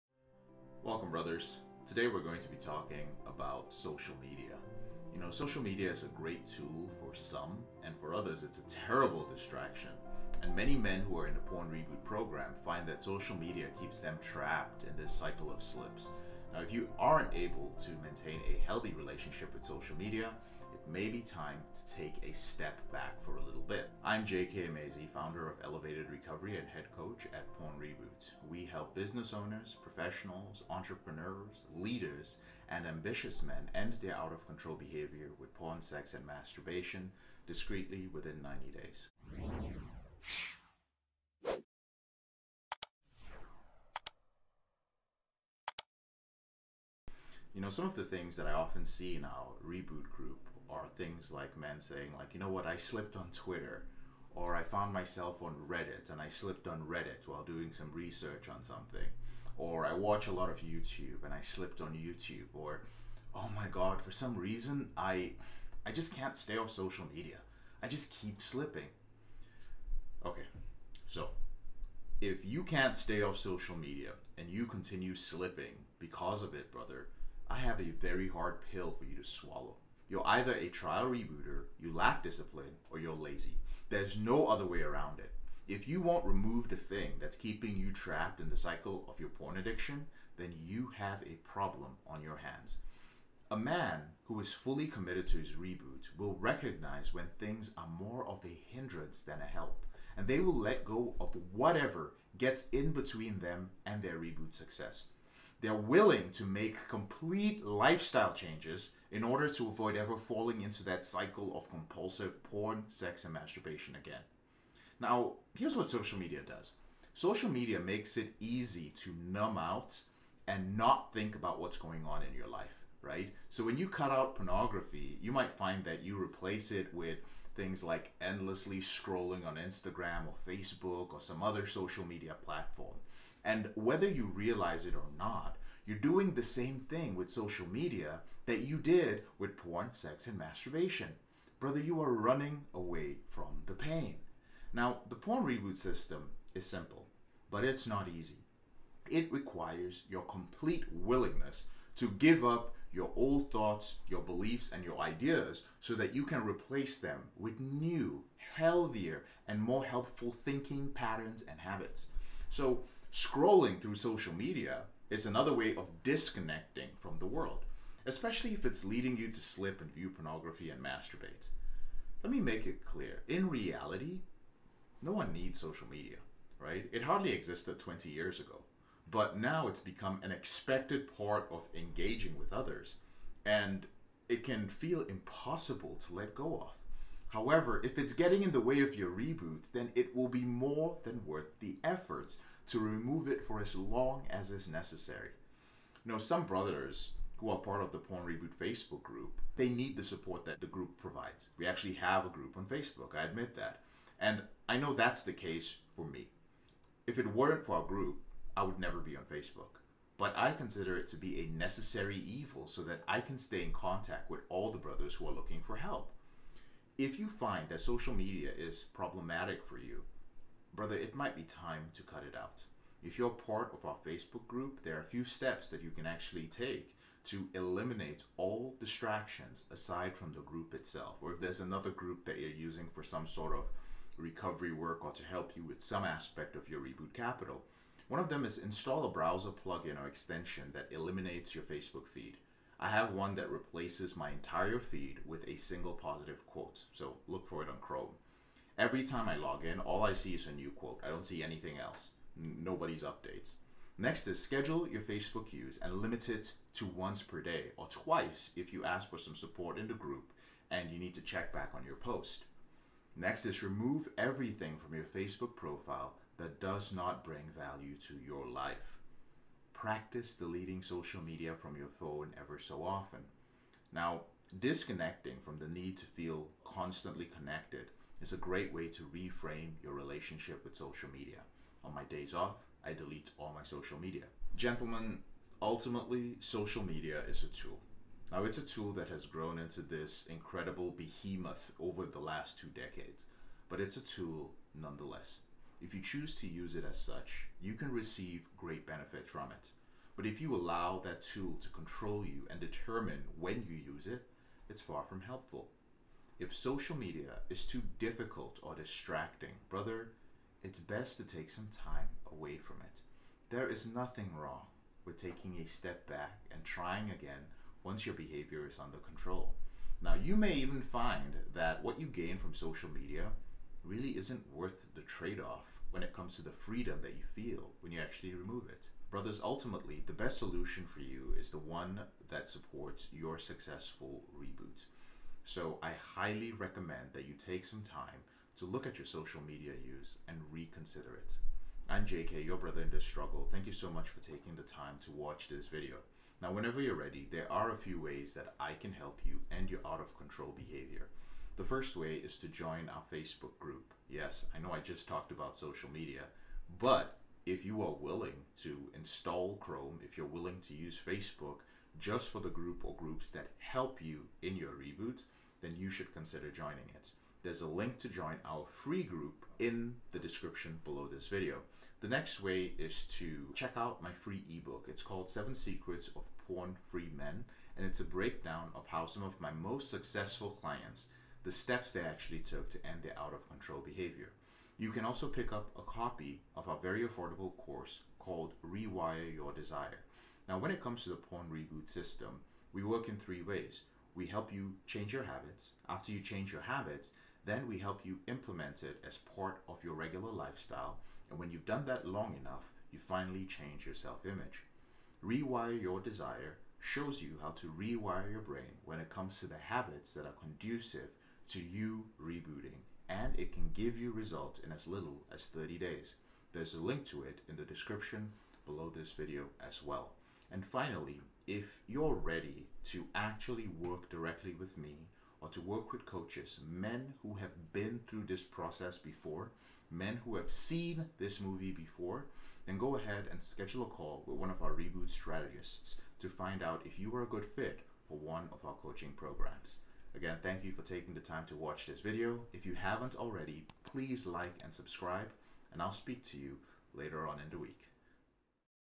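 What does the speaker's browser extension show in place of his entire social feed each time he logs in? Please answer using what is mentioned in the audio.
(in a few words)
a single positive quote.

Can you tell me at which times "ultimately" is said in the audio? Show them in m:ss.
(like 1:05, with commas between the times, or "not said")
4:45, 5:29.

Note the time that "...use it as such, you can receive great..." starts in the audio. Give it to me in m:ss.
4:56.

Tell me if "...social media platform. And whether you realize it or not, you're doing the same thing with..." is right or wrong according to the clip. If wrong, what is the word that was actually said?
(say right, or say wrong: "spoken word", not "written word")
right.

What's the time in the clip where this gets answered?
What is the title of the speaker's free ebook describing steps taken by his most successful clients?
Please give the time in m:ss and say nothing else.
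6:15.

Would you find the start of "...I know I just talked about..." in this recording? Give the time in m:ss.
5:54.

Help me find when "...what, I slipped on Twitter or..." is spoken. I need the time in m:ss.
0:52.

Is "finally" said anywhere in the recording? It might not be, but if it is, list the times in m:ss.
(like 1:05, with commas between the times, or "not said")
6:42, 7:00.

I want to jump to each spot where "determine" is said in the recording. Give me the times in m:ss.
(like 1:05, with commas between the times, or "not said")
5:02.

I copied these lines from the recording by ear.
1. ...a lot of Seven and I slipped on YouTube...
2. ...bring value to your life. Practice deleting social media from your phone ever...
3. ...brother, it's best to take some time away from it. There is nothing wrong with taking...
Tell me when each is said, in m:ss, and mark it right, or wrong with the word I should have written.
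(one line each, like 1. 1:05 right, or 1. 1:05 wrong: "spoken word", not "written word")
1. 1:00 wrong: "YouTube", not "Seven"
2. 4:27 right
3. 5:09 right.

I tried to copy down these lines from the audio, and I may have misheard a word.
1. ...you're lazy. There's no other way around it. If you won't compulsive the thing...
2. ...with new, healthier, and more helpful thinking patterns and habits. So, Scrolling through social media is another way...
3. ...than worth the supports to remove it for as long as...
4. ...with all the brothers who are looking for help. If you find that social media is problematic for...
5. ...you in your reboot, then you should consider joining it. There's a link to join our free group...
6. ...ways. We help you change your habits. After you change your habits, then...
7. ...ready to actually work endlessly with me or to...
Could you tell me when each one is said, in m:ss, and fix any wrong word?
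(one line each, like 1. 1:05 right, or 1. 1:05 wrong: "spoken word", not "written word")
1. 1:22 wrong: "remove", not "compulsive"
2. 2:37 right
3. 3:11 wrong: "efforts", not "supports"
4. 3:34 right
5. 6:04 right
6. 6:33 right
7. 7:02 wrong: "directly", not "endlessly".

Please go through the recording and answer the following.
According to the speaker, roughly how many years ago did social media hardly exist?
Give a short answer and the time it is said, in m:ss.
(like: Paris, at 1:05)
20, at 2:57.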